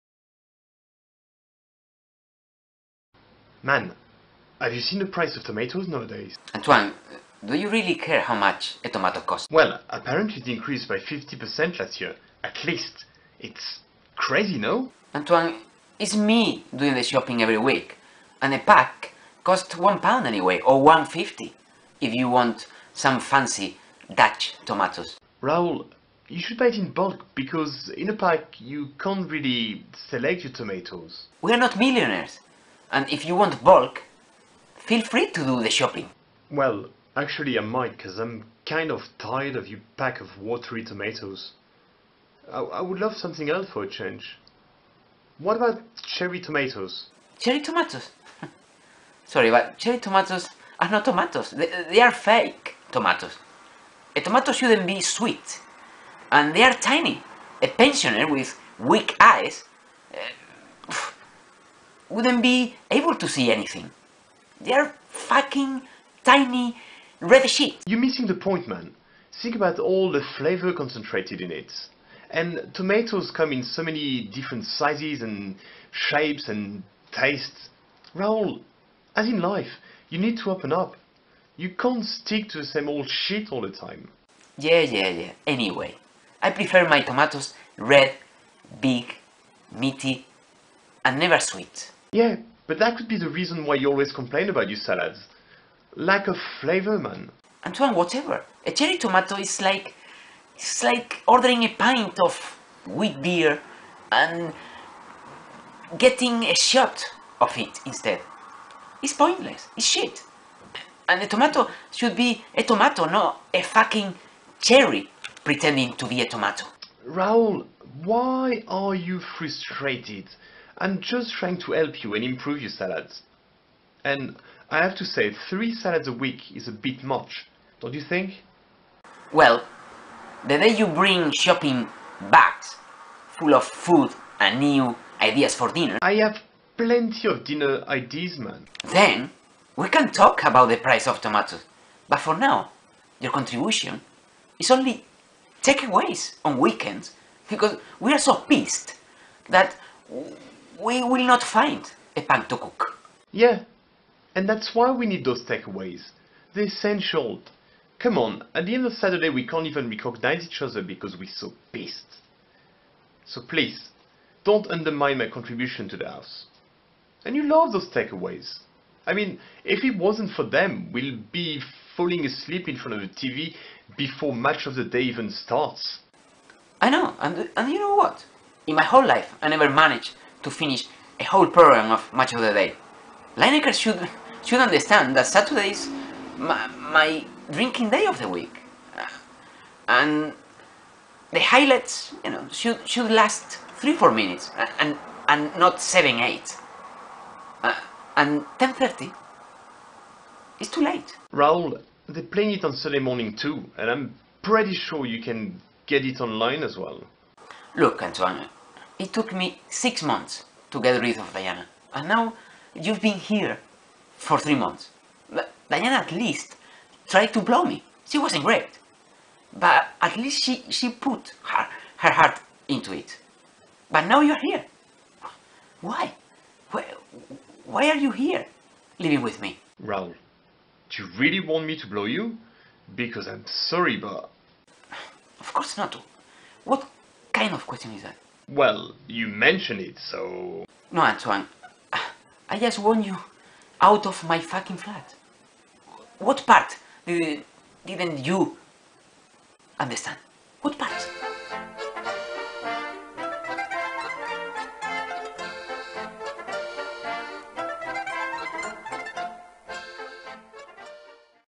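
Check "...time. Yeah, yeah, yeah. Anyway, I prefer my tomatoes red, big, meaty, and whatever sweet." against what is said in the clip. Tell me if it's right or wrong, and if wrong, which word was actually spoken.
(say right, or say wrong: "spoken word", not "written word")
wrong: "never", not "whatever".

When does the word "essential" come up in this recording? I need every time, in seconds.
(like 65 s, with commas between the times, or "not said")
156 s.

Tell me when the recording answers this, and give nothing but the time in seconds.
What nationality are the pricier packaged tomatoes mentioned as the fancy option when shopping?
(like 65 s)
24 s.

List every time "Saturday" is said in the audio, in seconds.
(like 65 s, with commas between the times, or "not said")
158 s, 185 s.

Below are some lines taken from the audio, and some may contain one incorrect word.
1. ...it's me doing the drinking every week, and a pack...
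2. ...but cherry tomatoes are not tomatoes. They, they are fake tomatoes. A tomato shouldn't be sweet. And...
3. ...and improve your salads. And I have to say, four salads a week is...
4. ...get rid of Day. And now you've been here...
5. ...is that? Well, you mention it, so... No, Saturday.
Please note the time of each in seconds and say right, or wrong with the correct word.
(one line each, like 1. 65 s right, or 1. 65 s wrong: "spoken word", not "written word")
1. 15 s wrong: "shopping", not "drinking"
2. 49 s right
3. 122 s wrong: "three", not "four"
4. 210 s wrong: "Diana", not "Day"
5. 237 s wrong: "Antoine", not "Saturday".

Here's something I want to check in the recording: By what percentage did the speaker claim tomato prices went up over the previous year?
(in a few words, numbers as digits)
50%.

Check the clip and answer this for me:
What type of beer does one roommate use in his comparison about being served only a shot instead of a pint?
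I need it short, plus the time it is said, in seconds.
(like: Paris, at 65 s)
Wheat beer, at 102 s.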